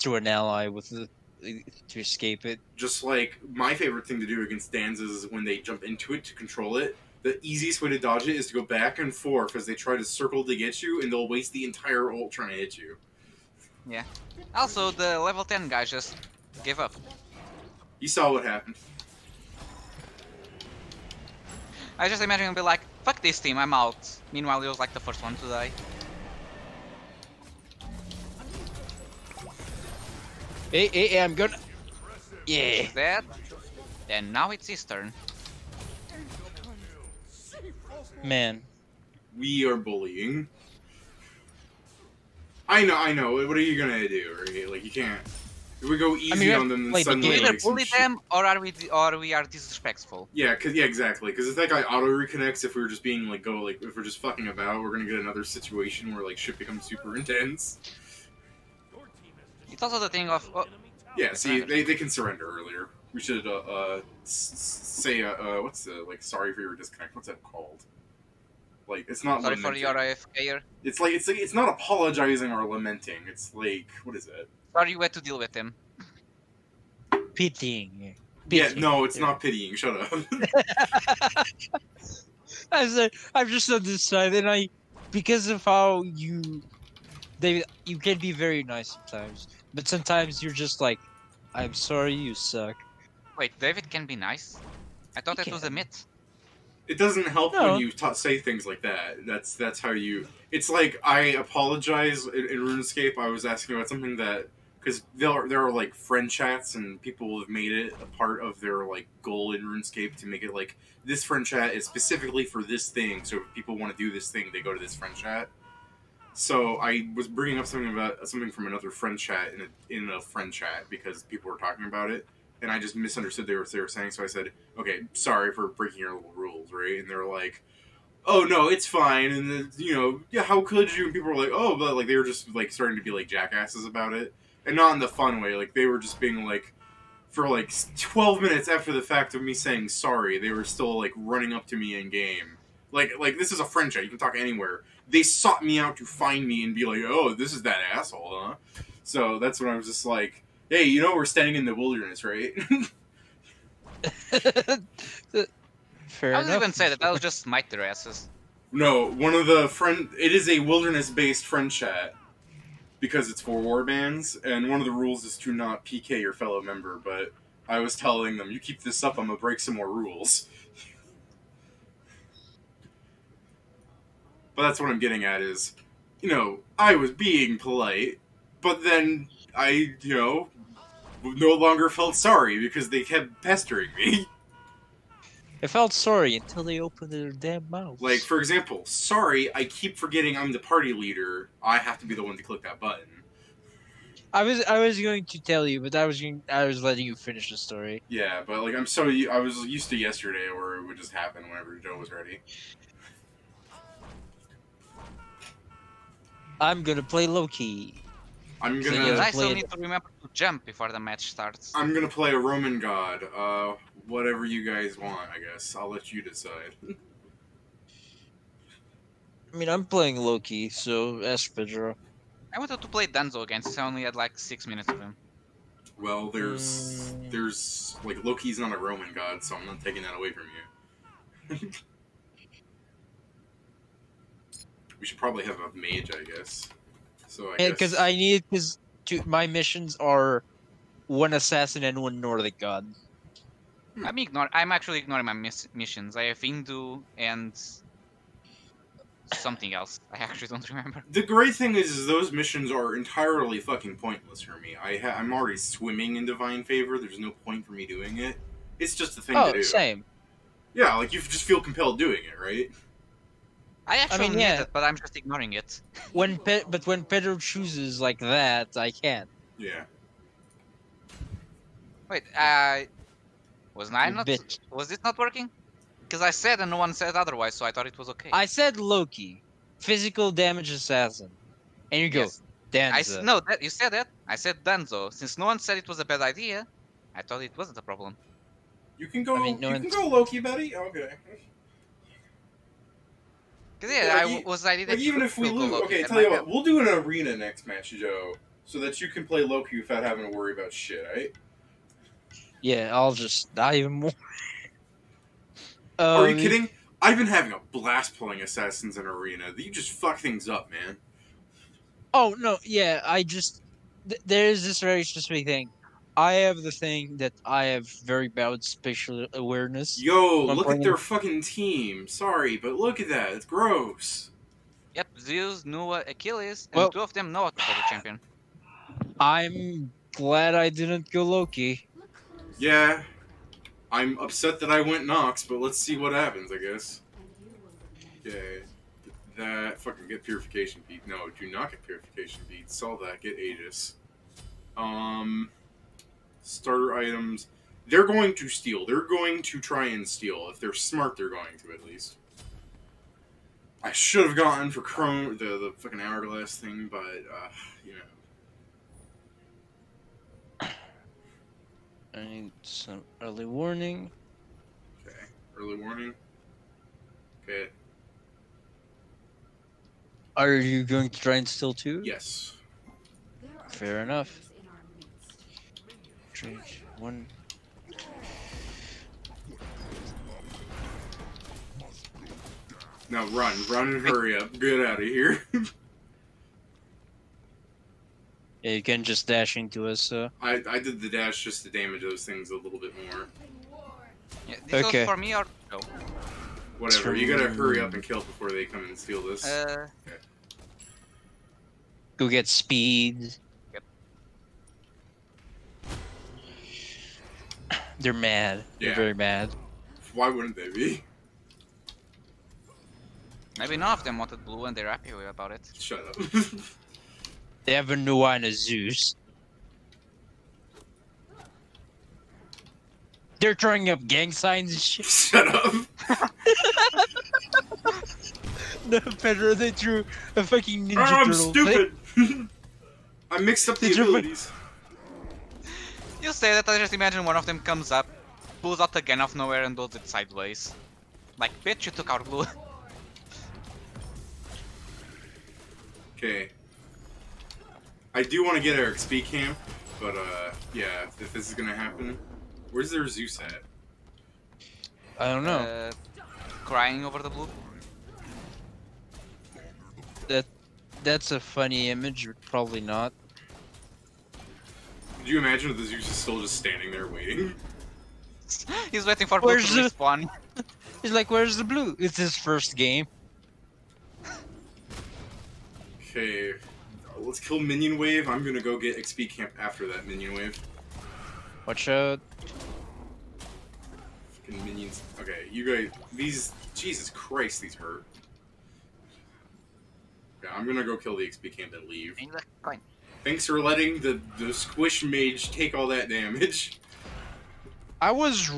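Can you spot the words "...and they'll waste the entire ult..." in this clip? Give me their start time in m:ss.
0:11.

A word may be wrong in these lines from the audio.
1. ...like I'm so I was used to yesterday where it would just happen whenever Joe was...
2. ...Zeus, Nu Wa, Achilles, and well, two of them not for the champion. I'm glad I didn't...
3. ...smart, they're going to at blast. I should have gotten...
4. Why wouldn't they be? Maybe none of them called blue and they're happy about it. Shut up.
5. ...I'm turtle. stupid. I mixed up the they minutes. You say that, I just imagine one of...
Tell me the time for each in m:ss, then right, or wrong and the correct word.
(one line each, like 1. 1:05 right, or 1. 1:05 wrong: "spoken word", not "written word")
1. 3:18 right
2. 5:25 right
3. 5:50 wrong: "least", not "blast"
4. 6:50 wrong: "wanted", not "called"
5. 7:11 wrong: "abilities", not "minutes".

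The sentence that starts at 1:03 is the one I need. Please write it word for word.
We should uh, uh say uh, uh, what's the like?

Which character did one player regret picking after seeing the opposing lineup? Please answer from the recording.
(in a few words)
Nox.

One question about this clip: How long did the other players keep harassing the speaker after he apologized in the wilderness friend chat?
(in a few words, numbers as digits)
12 minutes.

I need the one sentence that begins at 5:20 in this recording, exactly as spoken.
Yo, look at their fucking team.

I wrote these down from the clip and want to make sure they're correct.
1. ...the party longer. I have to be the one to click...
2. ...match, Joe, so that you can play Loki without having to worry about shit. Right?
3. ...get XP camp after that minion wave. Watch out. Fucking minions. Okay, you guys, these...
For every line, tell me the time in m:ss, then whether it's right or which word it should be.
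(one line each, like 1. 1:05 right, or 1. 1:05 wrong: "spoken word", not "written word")
1. 3:10 wrong: "leader", not "longer"
2. 4:57 right
3. 7:58 right.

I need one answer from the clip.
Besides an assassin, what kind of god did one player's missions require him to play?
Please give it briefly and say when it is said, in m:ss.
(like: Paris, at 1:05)
Nordic god, at 4:02.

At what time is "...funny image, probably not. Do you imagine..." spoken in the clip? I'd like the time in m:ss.
7:41.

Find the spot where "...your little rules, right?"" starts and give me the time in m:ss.
2:05.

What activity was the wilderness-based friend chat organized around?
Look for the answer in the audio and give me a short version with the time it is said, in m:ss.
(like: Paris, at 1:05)
war bands, at 2:43.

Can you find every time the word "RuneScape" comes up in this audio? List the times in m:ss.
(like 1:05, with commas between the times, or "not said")
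1:42, 1:49.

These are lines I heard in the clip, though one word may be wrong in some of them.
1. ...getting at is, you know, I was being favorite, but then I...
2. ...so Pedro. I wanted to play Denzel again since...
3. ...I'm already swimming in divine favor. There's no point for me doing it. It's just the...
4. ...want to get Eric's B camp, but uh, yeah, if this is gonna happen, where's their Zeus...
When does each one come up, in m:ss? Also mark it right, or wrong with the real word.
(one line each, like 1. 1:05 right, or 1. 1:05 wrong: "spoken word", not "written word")
1. 2:54 wrong: "polite", not "favorite"
2. 3:40 right
3. 4:15 right
4. 7:28 right.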